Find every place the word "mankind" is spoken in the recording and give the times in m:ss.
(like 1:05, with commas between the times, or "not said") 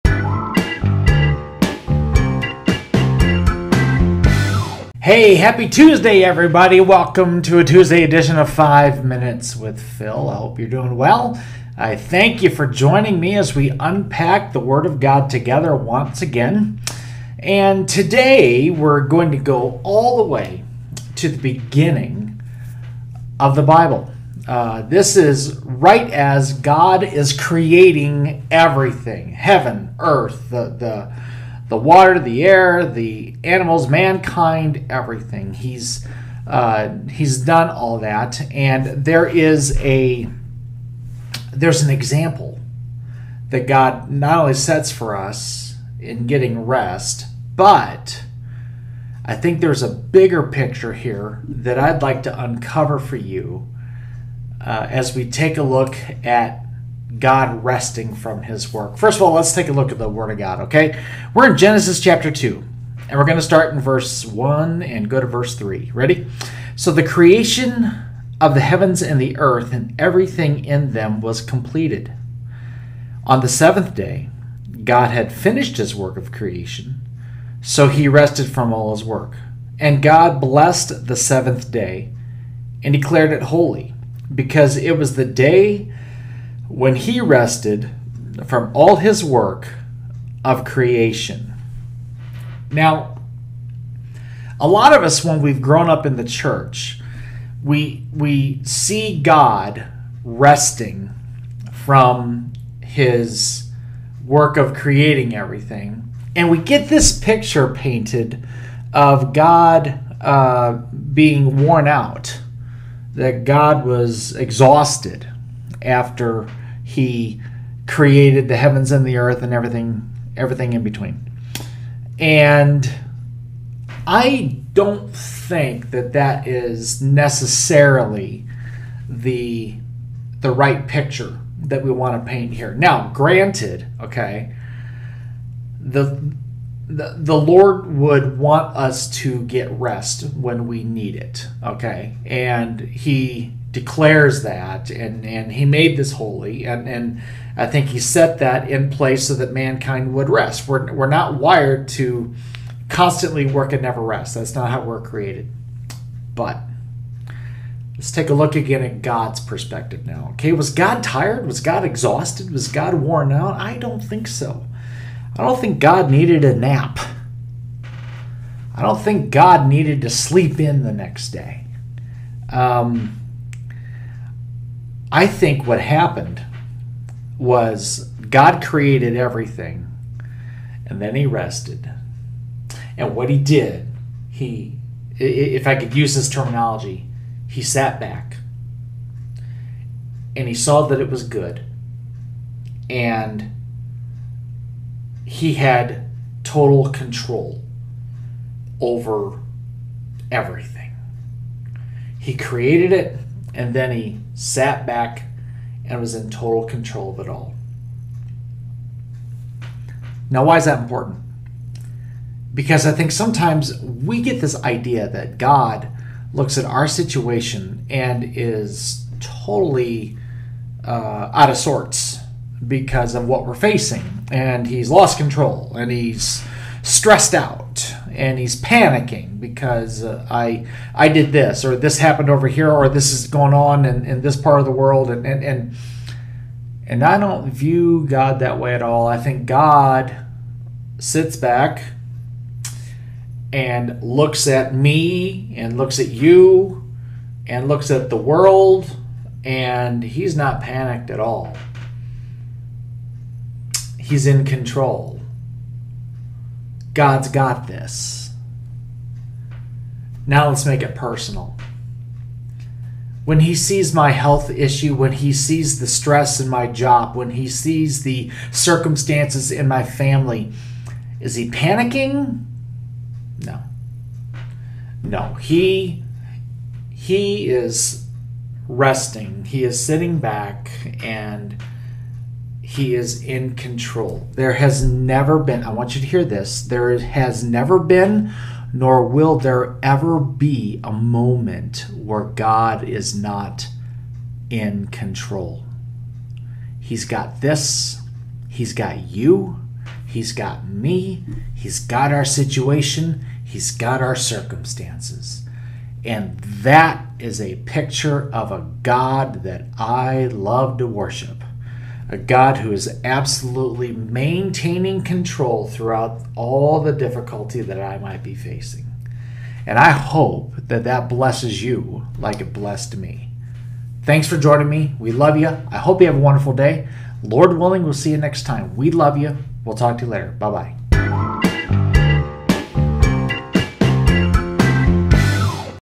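0:33, 2:29.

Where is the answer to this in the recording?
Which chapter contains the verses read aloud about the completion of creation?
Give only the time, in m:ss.
1:01.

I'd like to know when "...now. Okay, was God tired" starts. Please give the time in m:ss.
2:40.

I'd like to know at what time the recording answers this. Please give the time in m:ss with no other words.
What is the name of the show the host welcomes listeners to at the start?
0:08.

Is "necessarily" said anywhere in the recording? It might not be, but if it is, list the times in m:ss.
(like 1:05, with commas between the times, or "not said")
2:07.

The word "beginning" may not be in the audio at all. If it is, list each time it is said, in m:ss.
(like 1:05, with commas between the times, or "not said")
0:21.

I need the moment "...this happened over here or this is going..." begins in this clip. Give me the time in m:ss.
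3:51.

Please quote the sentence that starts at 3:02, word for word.
And what he did, he, if I could use this terminology, he sat back and he saw that it was good.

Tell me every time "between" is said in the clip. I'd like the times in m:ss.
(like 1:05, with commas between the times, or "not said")
2:00.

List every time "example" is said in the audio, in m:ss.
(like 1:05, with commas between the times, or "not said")
0:41.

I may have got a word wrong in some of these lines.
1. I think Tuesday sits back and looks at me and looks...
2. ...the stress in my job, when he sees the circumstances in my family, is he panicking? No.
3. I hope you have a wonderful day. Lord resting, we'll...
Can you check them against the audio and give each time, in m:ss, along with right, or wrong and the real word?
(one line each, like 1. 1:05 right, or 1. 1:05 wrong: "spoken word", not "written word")
1. 3:59 wrong: "God", not "Tuesday"
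2. 4:25 right
3. 5:25 wrong: "willing", not "resting".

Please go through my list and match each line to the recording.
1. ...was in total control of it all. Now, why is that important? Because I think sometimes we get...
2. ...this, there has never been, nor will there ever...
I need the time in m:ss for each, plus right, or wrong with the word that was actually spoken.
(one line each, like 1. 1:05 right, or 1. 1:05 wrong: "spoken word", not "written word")
1. 3:25 right
2. 4:46 right.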